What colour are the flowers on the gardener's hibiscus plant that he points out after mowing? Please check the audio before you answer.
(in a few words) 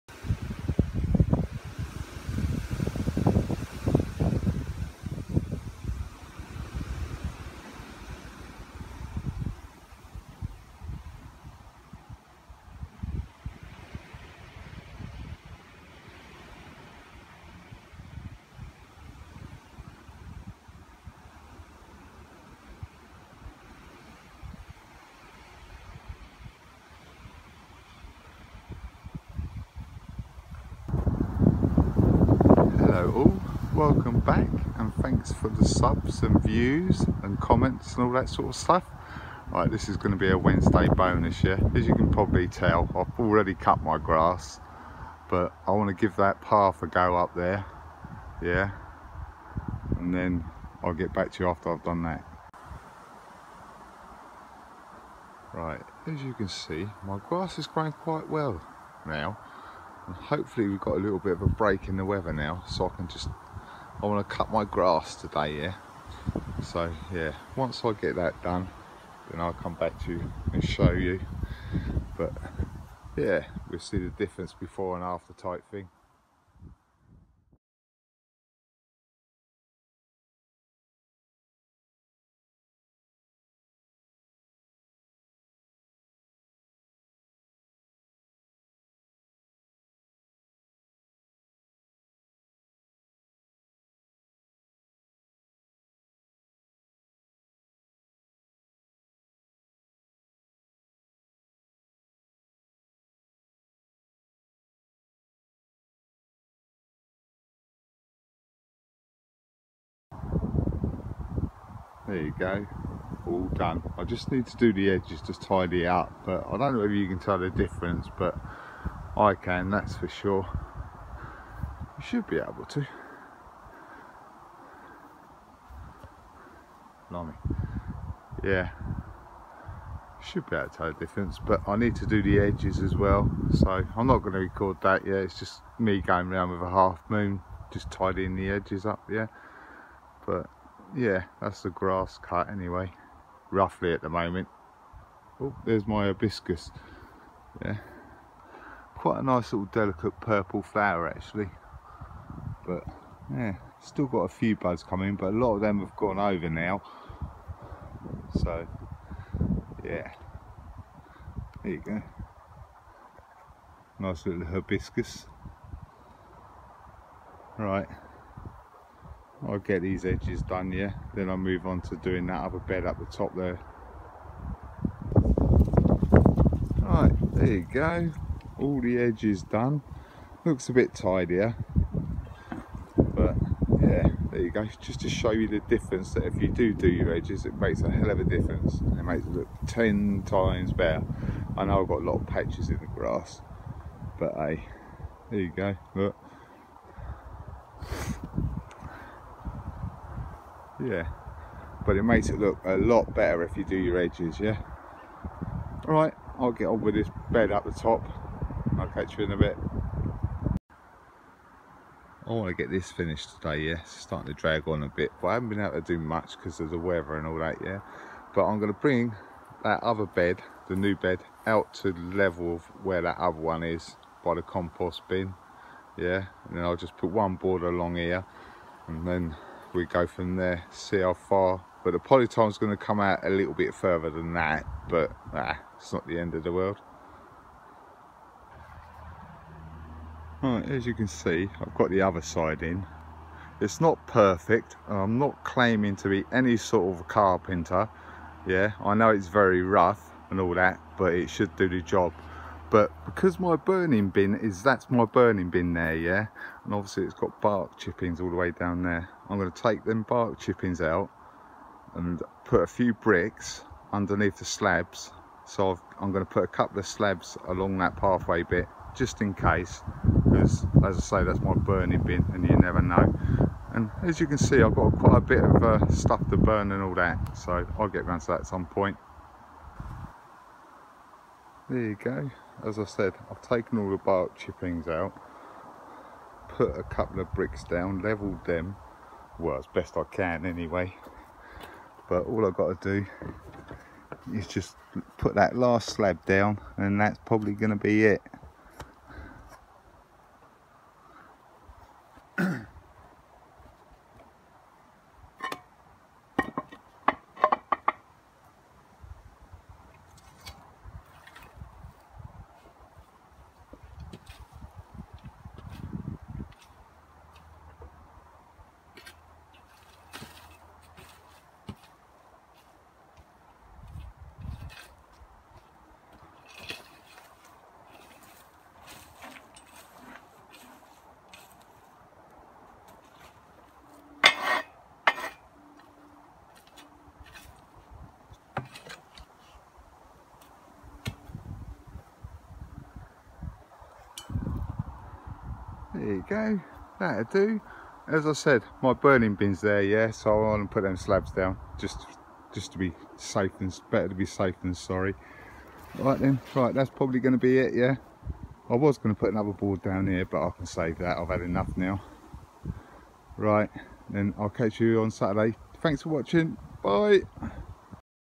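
Purple.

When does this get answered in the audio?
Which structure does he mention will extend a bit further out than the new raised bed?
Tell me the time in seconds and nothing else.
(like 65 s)
231 s.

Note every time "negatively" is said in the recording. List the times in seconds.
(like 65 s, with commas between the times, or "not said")
not said.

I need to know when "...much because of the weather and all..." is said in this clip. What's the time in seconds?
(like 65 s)
215 s.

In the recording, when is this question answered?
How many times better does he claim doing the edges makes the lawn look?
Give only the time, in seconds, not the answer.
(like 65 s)
189 s.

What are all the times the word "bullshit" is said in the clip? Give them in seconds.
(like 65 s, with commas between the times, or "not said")
not said.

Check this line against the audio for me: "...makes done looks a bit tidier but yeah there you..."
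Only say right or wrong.
wrong.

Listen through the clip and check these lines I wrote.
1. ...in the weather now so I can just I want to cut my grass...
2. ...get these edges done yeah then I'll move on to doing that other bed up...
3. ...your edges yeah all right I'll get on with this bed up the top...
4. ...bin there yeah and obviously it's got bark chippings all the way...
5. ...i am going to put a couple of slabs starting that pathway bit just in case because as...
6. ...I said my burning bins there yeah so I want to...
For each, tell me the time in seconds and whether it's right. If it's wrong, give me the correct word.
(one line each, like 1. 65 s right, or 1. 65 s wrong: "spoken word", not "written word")
1. 61 s right
2. 169 s right
3. 203 s right
4. 255 s right
5. 265 s wrong: "along", not "starting"
6. 348 s right.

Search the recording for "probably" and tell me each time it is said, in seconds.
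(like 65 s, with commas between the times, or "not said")
42 s, 297 s, 356 s.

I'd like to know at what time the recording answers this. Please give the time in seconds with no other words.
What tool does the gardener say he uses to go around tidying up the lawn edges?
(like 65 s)
136 s.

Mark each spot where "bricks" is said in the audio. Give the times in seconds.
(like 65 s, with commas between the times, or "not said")
262 s, 287 s.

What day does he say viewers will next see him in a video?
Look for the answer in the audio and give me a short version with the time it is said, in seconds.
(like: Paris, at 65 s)
Saturday, at 365 s.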